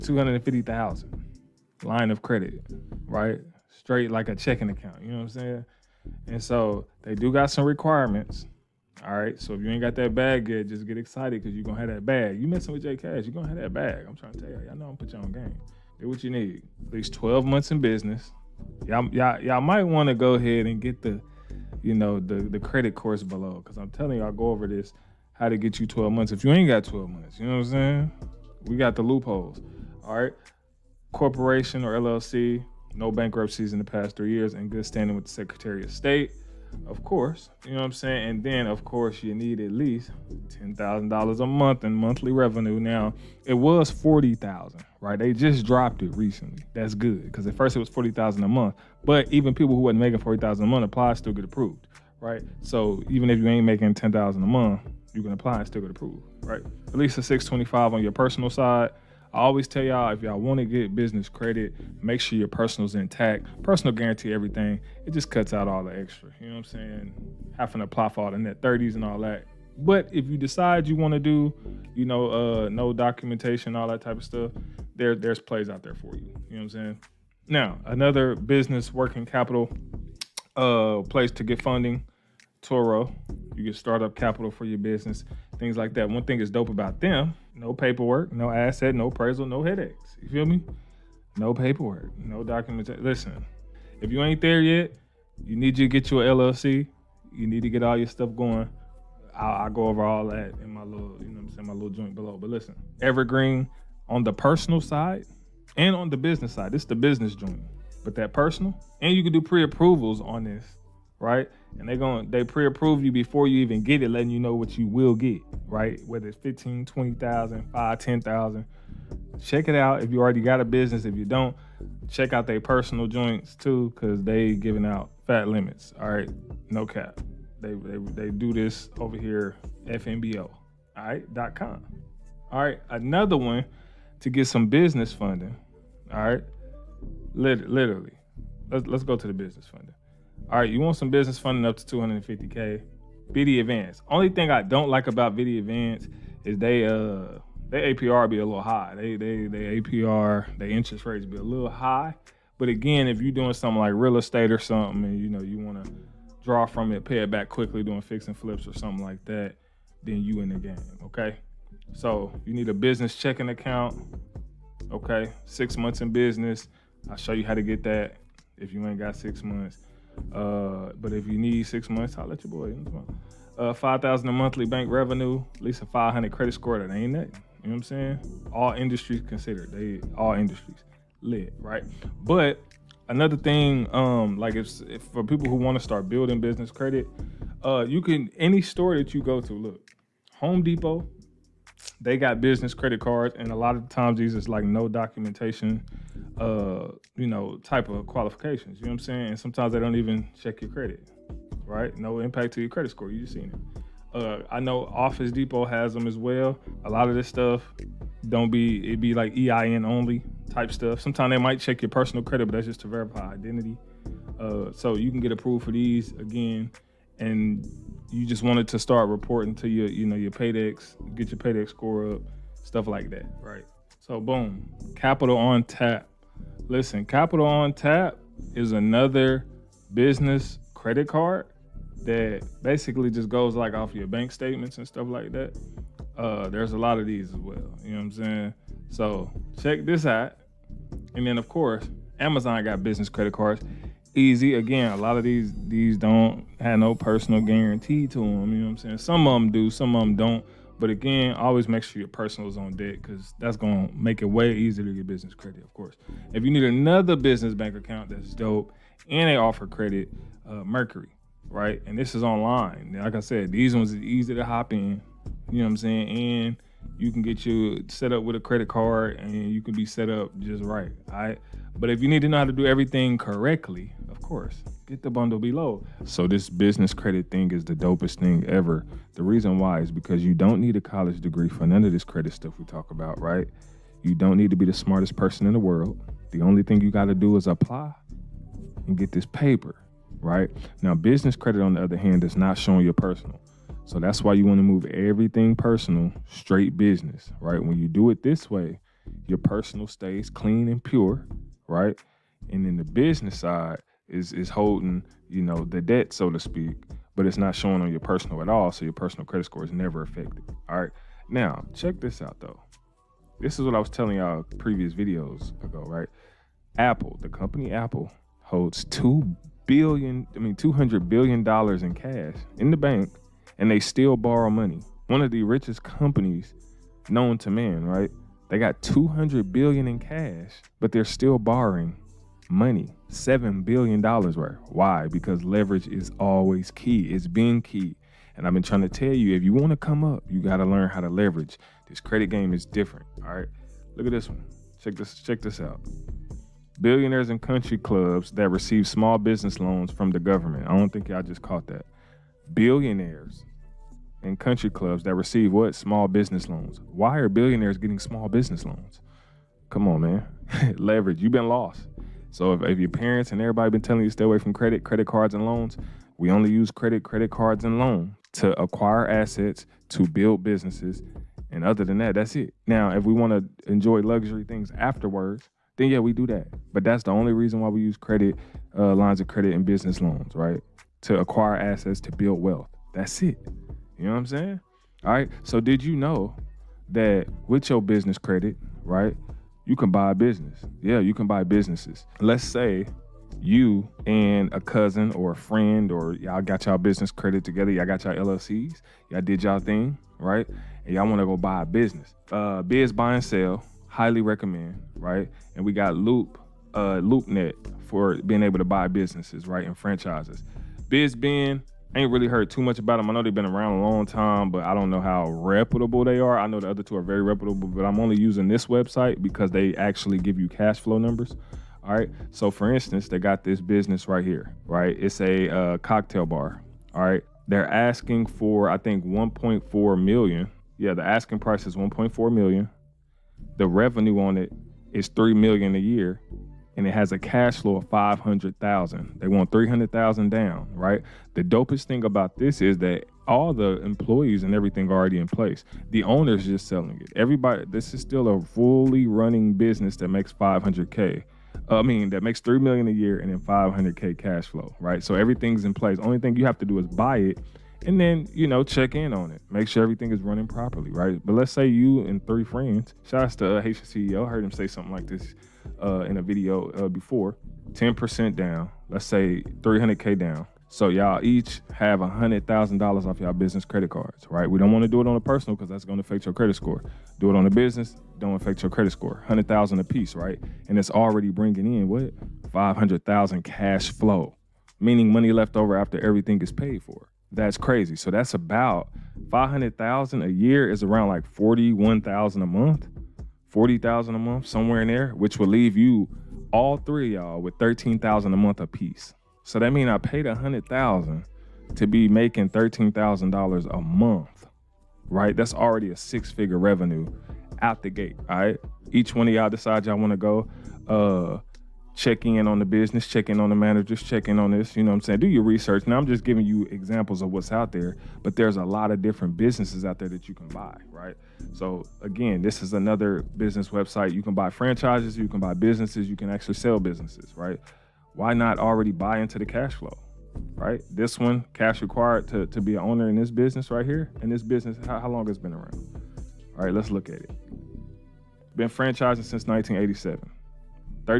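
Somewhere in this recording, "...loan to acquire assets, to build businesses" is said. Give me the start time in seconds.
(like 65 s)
367 s.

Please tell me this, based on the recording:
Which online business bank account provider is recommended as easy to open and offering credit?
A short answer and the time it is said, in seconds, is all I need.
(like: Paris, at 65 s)
Mercury, at 260 s.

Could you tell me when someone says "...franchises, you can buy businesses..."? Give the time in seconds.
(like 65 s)
524 s.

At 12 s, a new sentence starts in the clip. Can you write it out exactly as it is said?
You messing with J Cash, you're gonna have that bag.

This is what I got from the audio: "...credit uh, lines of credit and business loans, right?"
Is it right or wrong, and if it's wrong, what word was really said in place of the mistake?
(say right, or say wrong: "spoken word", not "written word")
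right.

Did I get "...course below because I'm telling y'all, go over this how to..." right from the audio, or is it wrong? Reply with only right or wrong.
right.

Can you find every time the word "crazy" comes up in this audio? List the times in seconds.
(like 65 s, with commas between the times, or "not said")
487 s.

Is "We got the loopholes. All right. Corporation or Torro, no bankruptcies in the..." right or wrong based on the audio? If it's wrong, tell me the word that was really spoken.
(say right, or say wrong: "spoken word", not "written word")
wrong: "LLC", not "Torro".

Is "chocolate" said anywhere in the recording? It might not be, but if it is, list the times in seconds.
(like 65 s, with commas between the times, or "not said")
not said.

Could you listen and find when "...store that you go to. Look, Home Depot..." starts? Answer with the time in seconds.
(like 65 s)
188 s.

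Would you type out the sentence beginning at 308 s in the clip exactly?
So your personal credit score is never affected.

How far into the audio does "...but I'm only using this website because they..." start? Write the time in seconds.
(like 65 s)
417 s.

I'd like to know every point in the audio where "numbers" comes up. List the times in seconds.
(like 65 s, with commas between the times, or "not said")
420 s.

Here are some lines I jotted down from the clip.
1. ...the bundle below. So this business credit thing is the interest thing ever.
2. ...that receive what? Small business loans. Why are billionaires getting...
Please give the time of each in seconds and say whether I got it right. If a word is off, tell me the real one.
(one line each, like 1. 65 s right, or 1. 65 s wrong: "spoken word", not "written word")
1. 275 s wrong: "dopest", not "interest"
2. 355 s right.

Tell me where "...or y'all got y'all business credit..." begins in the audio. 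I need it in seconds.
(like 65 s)
395 s.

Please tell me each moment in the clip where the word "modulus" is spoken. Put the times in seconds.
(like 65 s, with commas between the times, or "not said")
not said.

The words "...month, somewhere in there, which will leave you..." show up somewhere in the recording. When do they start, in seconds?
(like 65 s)
494 s.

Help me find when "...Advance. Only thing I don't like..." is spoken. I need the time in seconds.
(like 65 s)
143 s.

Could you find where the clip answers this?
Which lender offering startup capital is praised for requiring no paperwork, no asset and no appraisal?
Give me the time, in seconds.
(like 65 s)
82 s.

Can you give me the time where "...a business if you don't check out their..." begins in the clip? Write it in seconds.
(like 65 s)
120 s.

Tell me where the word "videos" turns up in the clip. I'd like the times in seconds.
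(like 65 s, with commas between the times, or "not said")
314 s, 466 s.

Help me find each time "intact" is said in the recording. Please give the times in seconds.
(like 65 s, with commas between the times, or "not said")
62 s.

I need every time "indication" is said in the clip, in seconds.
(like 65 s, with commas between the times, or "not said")
not said.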